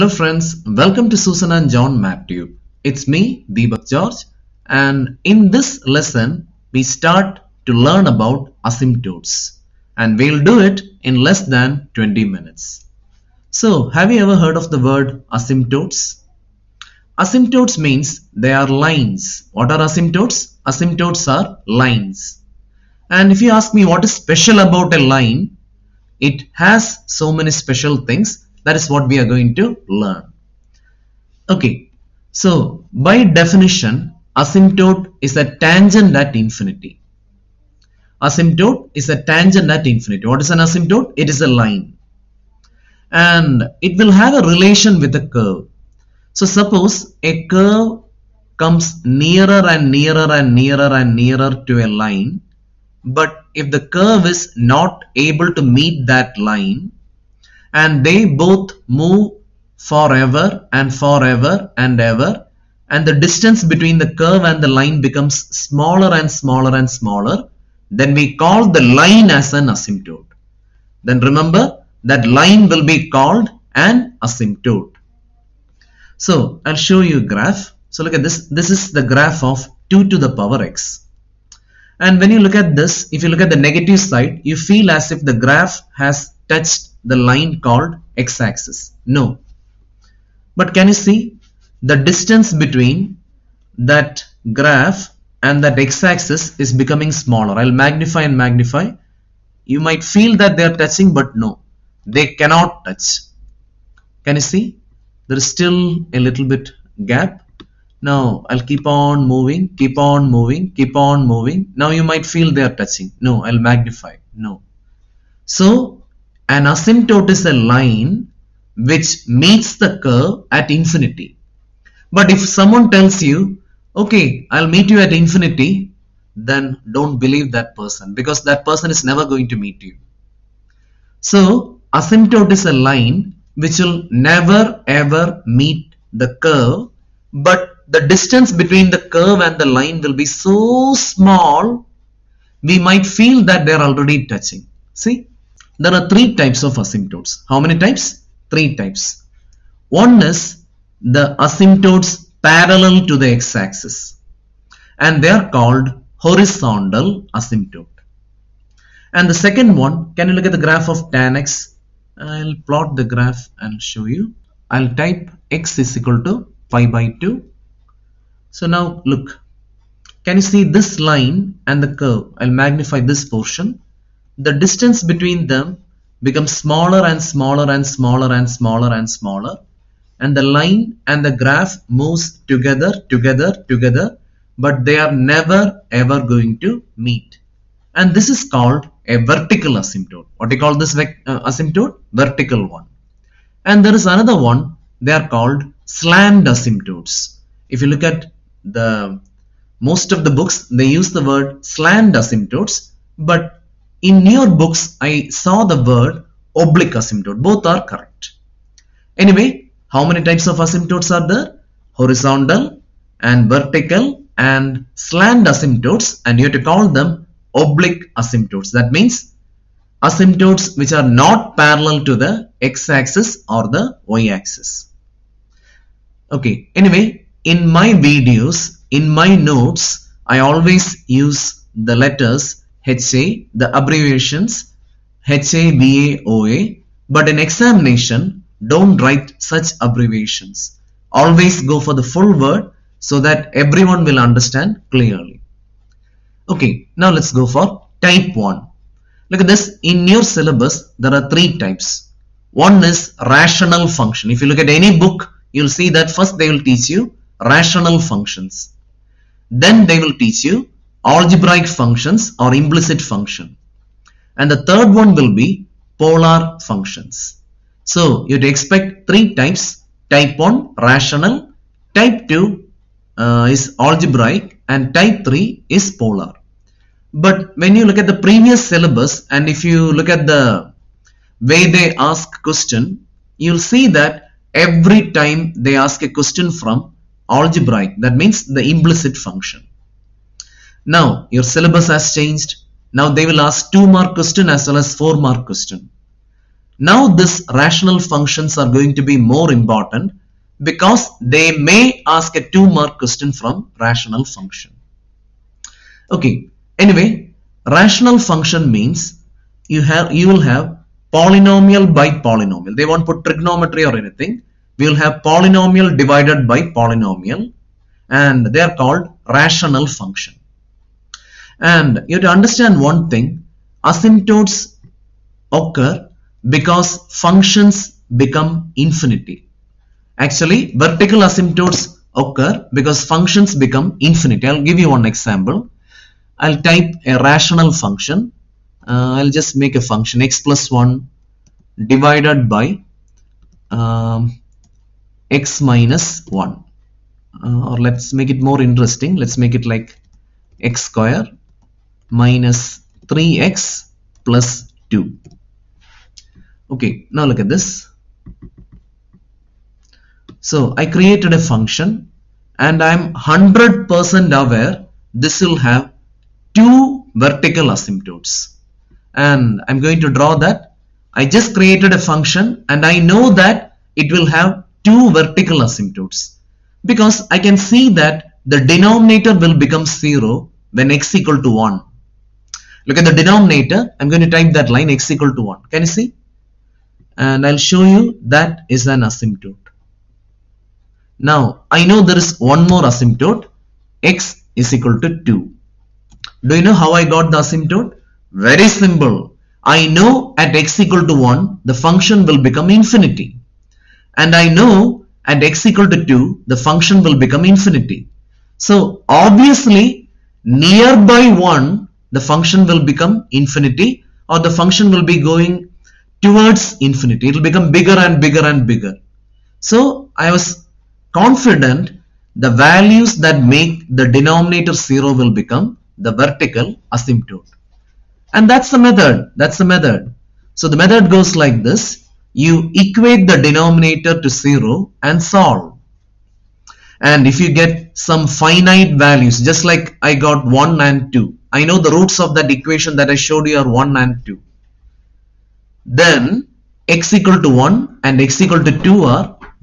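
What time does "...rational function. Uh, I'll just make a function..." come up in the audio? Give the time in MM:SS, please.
05:37.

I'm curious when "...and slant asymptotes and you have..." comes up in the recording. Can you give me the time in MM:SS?
03:34.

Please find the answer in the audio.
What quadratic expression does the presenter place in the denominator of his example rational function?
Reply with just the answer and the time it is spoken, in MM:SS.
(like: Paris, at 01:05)
x square minus 3x plus 2, at 05:50.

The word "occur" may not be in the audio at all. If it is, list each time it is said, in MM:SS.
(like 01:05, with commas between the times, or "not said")
05:25, 05:32.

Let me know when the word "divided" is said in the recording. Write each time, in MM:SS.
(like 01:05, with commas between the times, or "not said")
05:15, 05:41.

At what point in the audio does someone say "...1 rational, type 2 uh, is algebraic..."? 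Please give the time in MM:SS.
04:30.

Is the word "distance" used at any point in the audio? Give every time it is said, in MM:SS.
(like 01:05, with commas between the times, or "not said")
01:03, 01:32, 02:18, 02:54.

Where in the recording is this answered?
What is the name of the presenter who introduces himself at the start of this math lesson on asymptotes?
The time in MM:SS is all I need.
00:03.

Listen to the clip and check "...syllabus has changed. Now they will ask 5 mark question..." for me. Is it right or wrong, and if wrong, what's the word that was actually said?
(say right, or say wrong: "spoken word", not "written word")
wrong: "2", not "5".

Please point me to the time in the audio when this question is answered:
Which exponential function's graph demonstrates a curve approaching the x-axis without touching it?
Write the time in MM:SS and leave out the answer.
01:19.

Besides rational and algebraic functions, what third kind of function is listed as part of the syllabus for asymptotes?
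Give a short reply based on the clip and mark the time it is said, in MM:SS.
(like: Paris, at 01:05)
polar functions, at 04:25.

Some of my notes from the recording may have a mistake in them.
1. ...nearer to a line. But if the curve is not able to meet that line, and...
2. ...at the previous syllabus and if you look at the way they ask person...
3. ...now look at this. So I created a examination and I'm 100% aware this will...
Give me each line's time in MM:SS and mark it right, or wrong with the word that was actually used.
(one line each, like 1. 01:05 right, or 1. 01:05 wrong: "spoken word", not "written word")
1. 00:51 right
2. 04:37 wrong: "question", not "person"
3. 05:57 wrong: "function", not "examination".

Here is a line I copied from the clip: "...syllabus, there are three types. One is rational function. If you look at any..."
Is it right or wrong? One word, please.
right.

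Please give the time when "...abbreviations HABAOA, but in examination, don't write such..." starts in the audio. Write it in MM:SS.
03:53.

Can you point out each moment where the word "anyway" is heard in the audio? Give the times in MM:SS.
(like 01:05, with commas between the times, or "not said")
03:29, 03:46, 05:06.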